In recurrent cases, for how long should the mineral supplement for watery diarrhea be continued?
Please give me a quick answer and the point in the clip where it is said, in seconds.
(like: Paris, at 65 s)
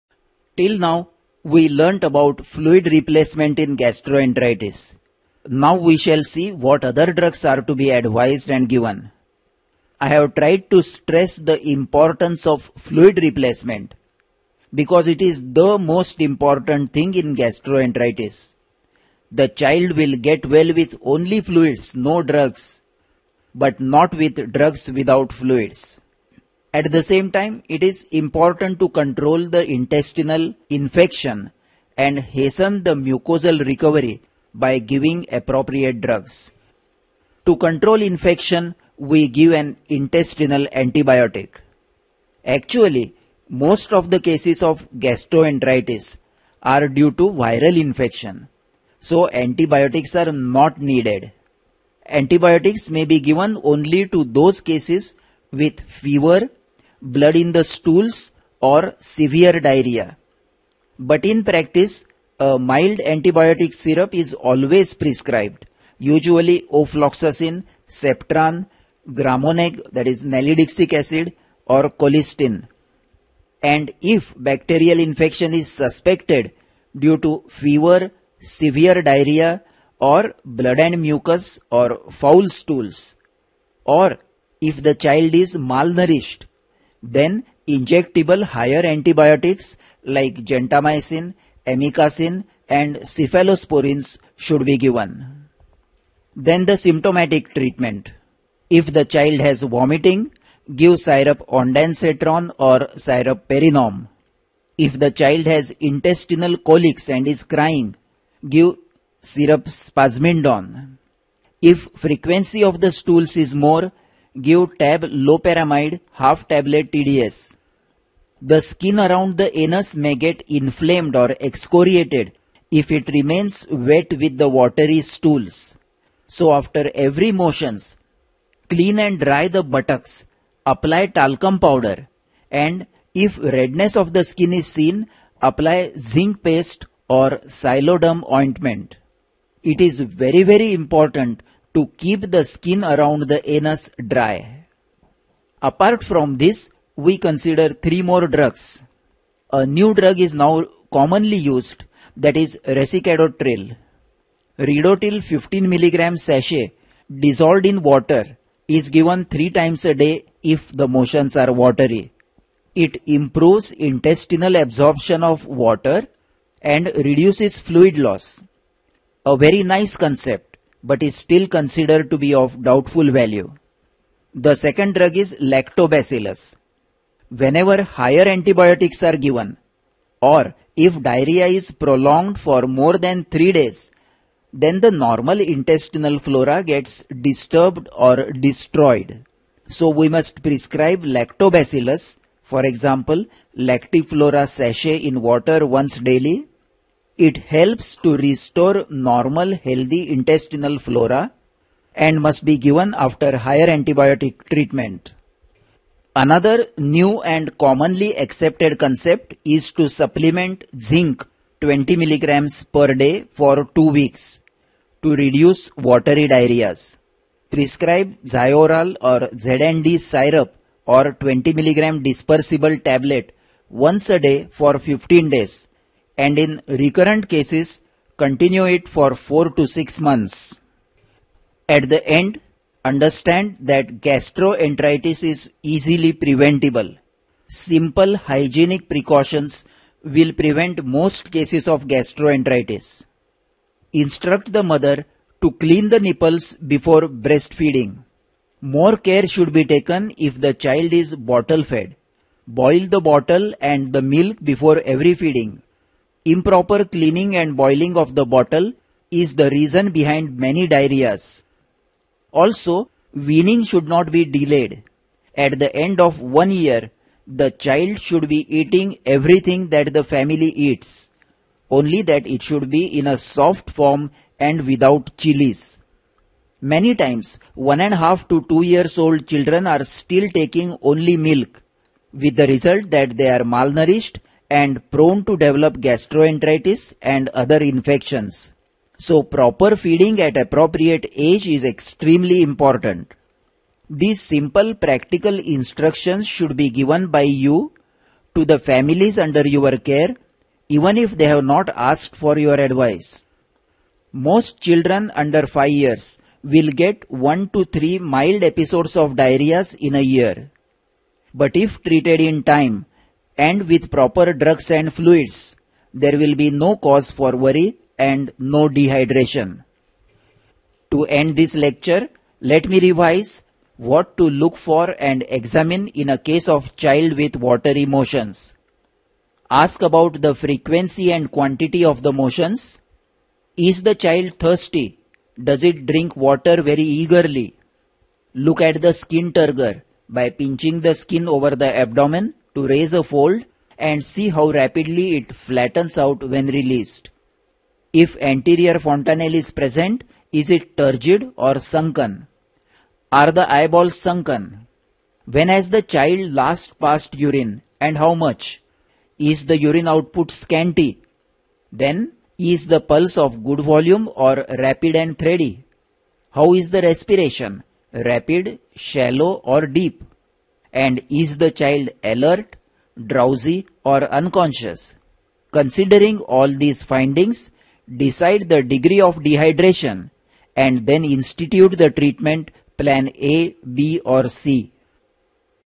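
4 to 6 months, at 229 s.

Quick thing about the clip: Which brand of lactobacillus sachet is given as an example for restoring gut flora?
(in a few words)
Lactiflora.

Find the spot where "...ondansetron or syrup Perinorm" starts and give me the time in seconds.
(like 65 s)
101 s.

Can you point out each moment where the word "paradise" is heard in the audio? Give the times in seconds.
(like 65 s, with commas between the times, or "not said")
not said.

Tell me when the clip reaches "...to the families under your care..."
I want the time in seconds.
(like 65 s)
298 s.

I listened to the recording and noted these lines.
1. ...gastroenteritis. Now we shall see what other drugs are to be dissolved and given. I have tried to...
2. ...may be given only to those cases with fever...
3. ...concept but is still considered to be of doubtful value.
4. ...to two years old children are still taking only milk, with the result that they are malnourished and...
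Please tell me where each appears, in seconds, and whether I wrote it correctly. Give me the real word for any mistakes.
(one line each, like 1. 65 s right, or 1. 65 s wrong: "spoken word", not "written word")
1. 3 s wrong: "advised", not "dissolved"
2. 52 s right
3. 169 s right
4. 278 s right.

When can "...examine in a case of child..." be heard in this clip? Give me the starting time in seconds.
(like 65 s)
325 s.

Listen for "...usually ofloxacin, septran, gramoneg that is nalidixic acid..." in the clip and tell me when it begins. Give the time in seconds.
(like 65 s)
65 s.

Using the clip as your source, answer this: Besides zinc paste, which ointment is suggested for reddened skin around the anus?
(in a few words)
Xyloderm.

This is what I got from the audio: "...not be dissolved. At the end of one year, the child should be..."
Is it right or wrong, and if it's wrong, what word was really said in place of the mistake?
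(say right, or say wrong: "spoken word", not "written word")
wrong: "delayed", not "dissolved".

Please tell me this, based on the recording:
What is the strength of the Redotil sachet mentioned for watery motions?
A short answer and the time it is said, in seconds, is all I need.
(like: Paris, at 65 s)
15 mg, at 155 s.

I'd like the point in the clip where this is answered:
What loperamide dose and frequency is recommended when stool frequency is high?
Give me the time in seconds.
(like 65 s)
116 s.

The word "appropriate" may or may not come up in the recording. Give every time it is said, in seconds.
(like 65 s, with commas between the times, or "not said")
35 s, 290 s.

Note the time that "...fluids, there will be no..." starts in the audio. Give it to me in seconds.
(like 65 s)
314 s.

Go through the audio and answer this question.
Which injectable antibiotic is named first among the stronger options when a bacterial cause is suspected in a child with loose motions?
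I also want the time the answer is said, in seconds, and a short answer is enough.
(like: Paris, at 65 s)
Gentamicin, at 90 s.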